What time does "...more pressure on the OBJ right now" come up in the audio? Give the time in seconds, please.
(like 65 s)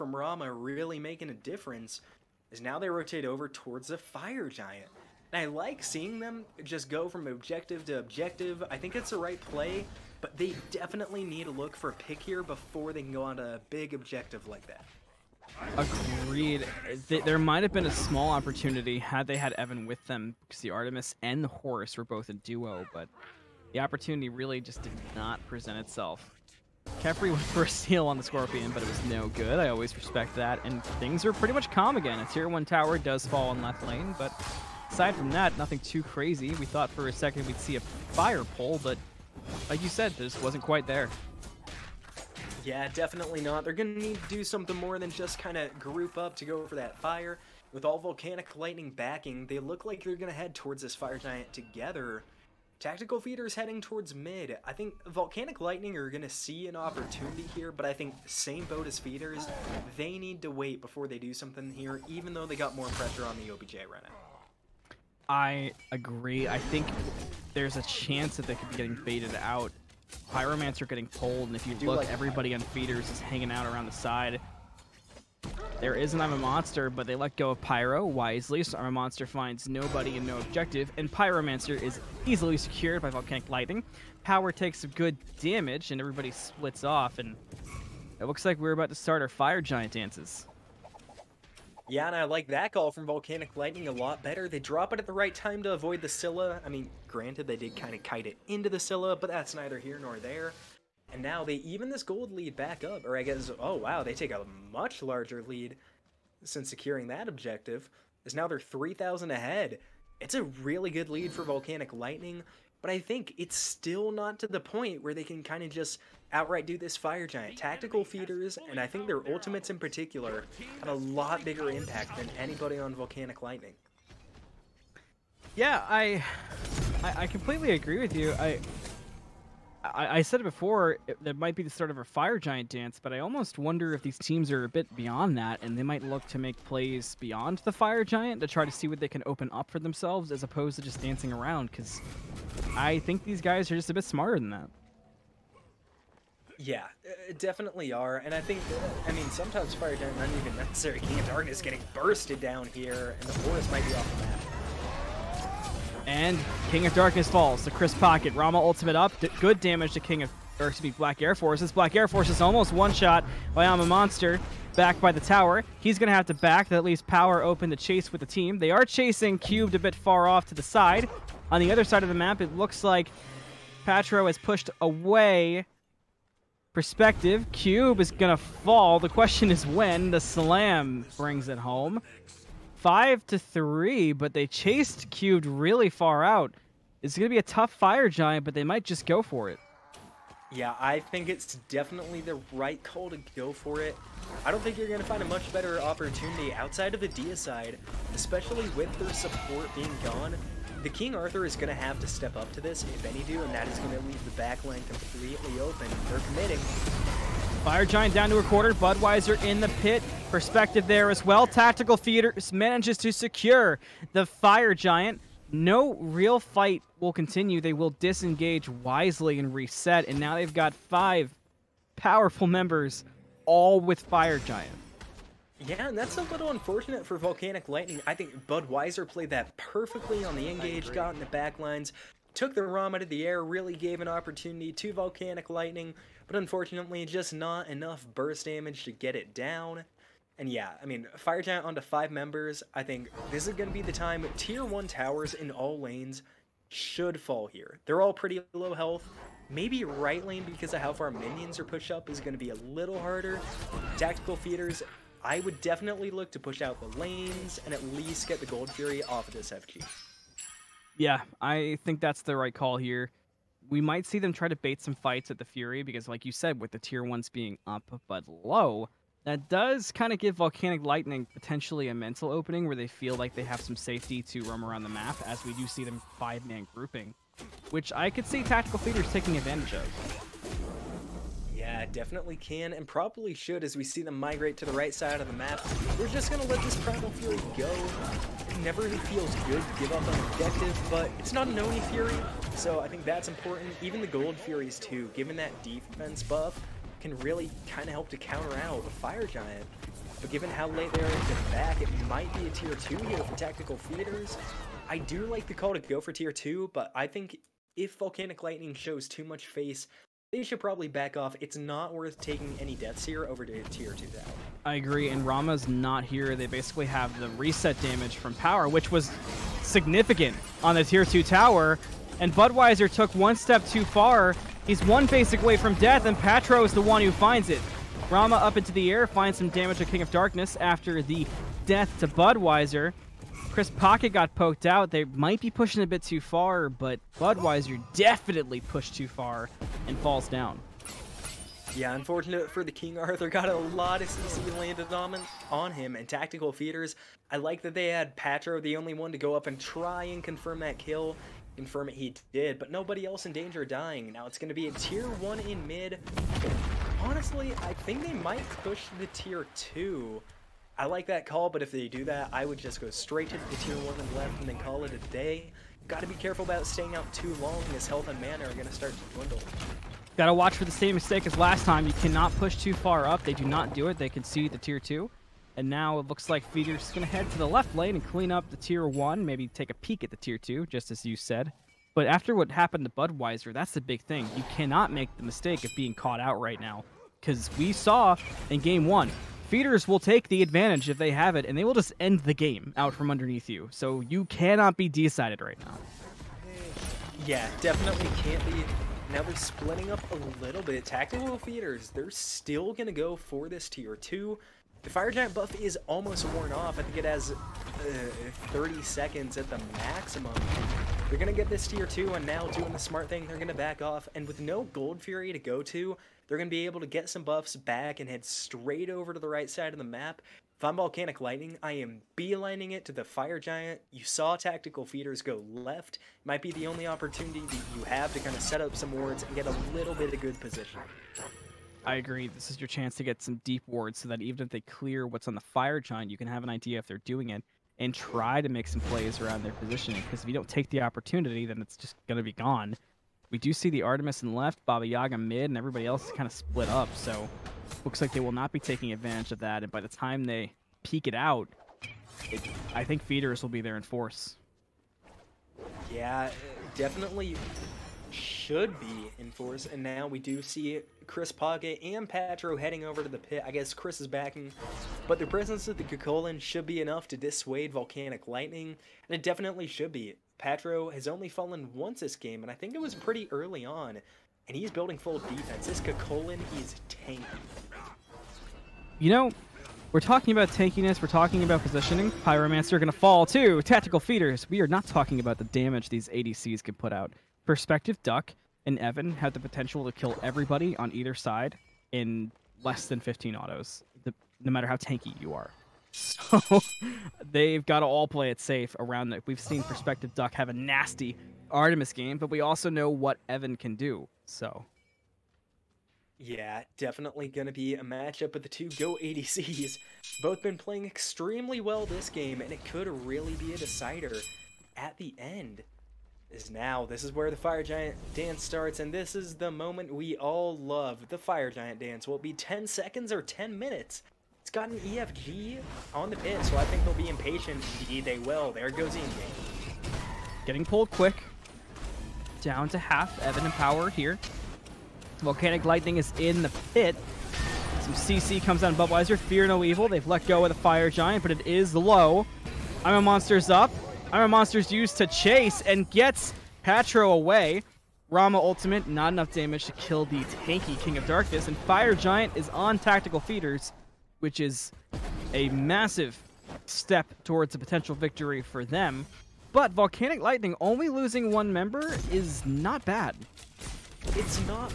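62 s.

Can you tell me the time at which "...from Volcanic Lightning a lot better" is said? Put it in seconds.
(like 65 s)
92 s.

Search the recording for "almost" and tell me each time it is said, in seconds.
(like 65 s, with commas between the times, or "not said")
133 s, 162 s, 405 s.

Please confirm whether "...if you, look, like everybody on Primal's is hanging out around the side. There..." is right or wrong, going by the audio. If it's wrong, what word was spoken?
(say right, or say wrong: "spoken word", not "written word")
wrong: "Feeder", not "Primal".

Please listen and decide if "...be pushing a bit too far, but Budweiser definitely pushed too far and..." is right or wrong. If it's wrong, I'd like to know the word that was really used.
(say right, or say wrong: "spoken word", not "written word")
right.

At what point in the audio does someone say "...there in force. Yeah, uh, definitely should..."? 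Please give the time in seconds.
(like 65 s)
453 s.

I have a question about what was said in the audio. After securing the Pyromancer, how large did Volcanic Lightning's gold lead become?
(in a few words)
3,000.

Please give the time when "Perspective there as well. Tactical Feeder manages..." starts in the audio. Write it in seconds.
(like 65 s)
210 s.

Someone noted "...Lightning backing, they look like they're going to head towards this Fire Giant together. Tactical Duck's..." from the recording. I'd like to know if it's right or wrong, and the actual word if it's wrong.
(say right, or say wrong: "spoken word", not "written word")
wrong: "Feeder", not "Duck".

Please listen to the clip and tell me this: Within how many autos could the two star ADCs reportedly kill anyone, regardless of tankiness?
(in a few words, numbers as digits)
15.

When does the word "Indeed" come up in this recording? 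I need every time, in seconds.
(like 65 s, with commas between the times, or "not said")
527 s.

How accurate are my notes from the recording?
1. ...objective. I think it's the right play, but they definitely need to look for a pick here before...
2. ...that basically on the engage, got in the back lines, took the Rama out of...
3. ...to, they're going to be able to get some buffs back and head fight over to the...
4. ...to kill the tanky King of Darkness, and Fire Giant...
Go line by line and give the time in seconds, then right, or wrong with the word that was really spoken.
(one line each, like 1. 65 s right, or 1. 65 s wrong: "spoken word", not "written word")
1. 7 s right
2. 229 s wrong: "perfectly", not "basically"
3. 415 s wrong: "straight", not "fight"
4. 549 s right.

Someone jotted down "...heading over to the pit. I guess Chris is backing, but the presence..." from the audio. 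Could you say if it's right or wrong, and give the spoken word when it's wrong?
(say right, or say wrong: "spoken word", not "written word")
right.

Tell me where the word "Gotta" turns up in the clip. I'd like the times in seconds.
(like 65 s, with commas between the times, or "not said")
365 s, 370 s.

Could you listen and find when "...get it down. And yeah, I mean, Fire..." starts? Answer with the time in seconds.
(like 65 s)
238 s.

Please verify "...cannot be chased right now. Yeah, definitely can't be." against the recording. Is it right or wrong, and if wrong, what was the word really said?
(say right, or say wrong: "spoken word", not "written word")
wrong: "decided", not "chased".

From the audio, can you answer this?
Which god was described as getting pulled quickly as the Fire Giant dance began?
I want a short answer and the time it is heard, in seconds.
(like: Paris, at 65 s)
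Inge, at 528 s.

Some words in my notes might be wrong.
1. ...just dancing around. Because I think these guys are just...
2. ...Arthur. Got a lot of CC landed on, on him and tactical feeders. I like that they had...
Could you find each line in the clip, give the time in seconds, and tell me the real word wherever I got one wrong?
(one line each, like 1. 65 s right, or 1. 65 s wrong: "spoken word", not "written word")
1. 140 s right
2. 342 s right.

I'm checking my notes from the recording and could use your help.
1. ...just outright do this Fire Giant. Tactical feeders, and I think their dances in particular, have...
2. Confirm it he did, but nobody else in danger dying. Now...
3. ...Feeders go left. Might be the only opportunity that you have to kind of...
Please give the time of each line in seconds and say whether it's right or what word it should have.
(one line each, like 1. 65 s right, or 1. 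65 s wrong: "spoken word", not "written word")
1. 115 s wrong: "ultimates", not "dances"
2. 351 s right
3. 424 s right.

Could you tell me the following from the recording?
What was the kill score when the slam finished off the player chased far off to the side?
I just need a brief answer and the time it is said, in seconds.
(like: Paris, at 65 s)
5 to 3, at 182 s.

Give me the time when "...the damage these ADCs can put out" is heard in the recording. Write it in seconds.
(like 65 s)
485 s.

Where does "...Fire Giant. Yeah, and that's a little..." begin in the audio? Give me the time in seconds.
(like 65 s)
223 s.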